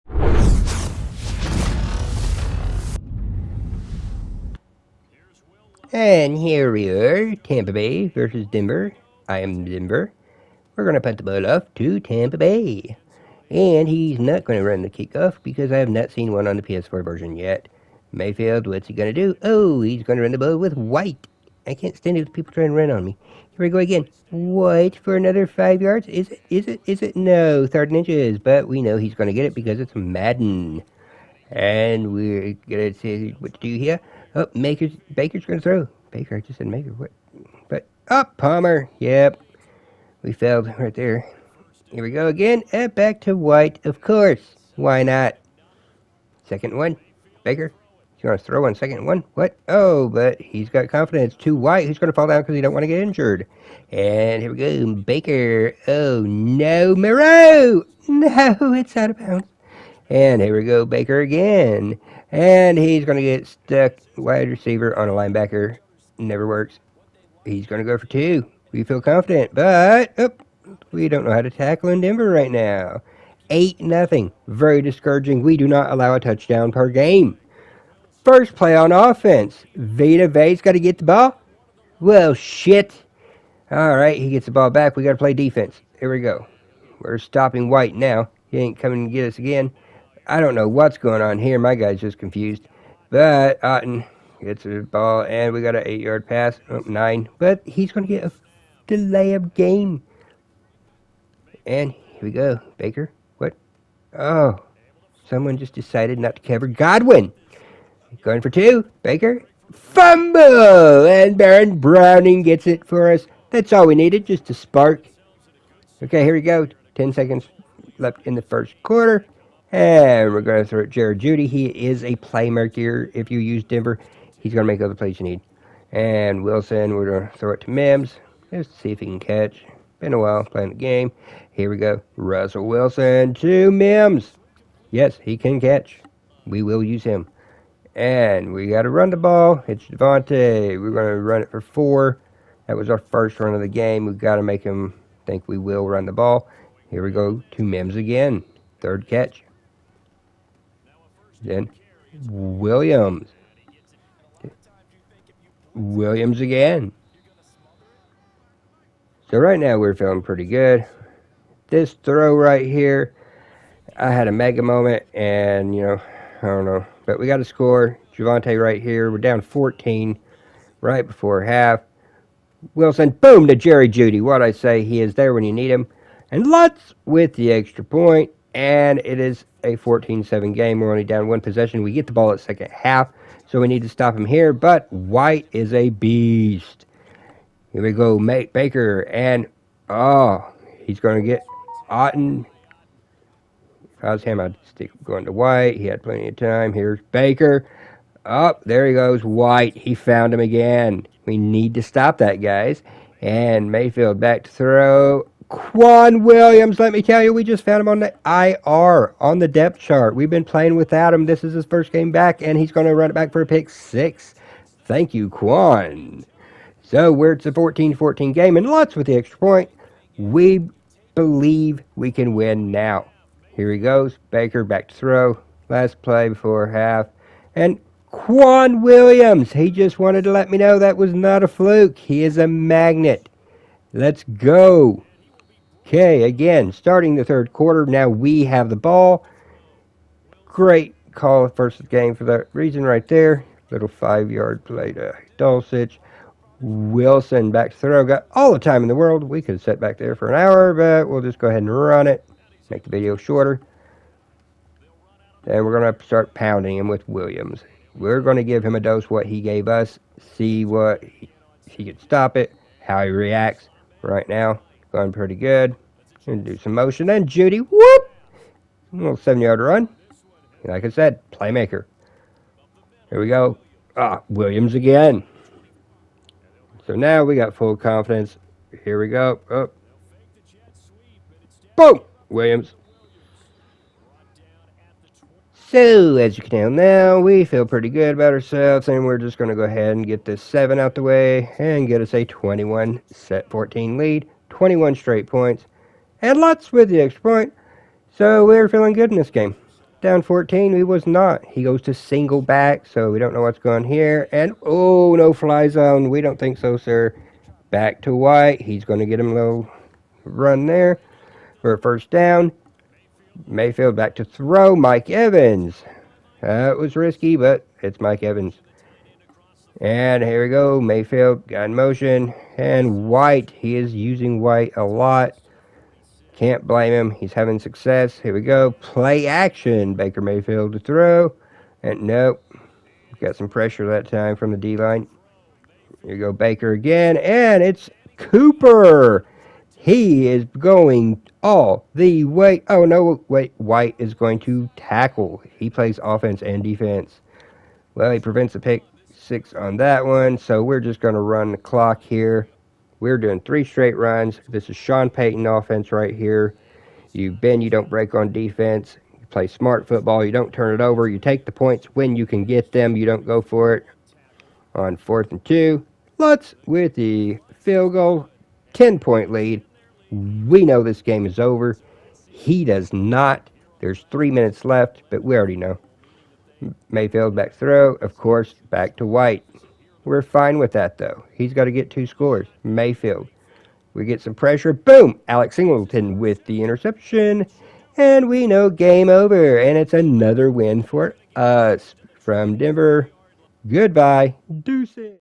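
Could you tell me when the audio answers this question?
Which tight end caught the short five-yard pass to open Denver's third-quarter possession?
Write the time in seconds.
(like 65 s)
245 s.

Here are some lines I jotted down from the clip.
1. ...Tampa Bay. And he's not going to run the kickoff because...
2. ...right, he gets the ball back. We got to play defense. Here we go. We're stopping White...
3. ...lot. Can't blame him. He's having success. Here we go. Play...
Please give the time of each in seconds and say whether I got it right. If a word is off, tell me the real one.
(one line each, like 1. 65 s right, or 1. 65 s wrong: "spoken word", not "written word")
1. 11 s right
2. 83 s right
3. 324 s right.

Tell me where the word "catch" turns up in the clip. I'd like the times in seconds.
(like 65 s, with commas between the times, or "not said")
129 s, 135 s, 149 s.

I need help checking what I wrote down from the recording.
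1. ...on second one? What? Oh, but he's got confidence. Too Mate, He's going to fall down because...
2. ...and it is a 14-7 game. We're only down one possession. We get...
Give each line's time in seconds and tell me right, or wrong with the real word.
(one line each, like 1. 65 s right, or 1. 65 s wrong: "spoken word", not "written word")
1. 48 s wrong: "White", not "Mate"
2. 178 s right.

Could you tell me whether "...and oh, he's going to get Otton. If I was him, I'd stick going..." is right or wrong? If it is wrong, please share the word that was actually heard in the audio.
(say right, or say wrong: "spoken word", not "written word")
right.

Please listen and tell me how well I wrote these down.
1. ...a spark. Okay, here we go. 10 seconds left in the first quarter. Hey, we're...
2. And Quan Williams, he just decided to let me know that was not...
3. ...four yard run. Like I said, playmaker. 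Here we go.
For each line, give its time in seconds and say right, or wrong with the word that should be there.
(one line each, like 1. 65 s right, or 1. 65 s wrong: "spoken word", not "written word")
1. 114 s right
2. 227 s wrong: "wanted", not "decided"
3. 269 s wrong: "seven", not "four".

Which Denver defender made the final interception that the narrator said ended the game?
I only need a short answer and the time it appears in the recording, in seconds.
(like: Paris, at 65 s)
Alex Singleton, at 385 s.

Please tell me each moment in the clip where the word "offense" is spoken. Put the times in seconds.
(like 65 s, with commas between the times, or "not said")
78 s, 346 s, 355 s.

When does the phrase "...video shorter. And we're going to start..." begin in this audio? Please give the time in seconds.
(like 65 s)
252 s.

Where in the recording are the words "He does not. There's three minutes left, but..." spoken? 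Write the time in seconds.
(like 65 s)
372 s.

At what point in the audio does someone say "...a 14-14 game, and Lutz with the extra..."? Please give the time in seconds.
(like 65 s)
217 s.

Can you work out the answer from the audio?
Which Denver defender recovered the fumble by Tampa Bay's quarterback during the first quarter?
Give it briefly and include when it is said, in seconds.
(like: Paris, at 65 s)
Baron Browning, at 111 s.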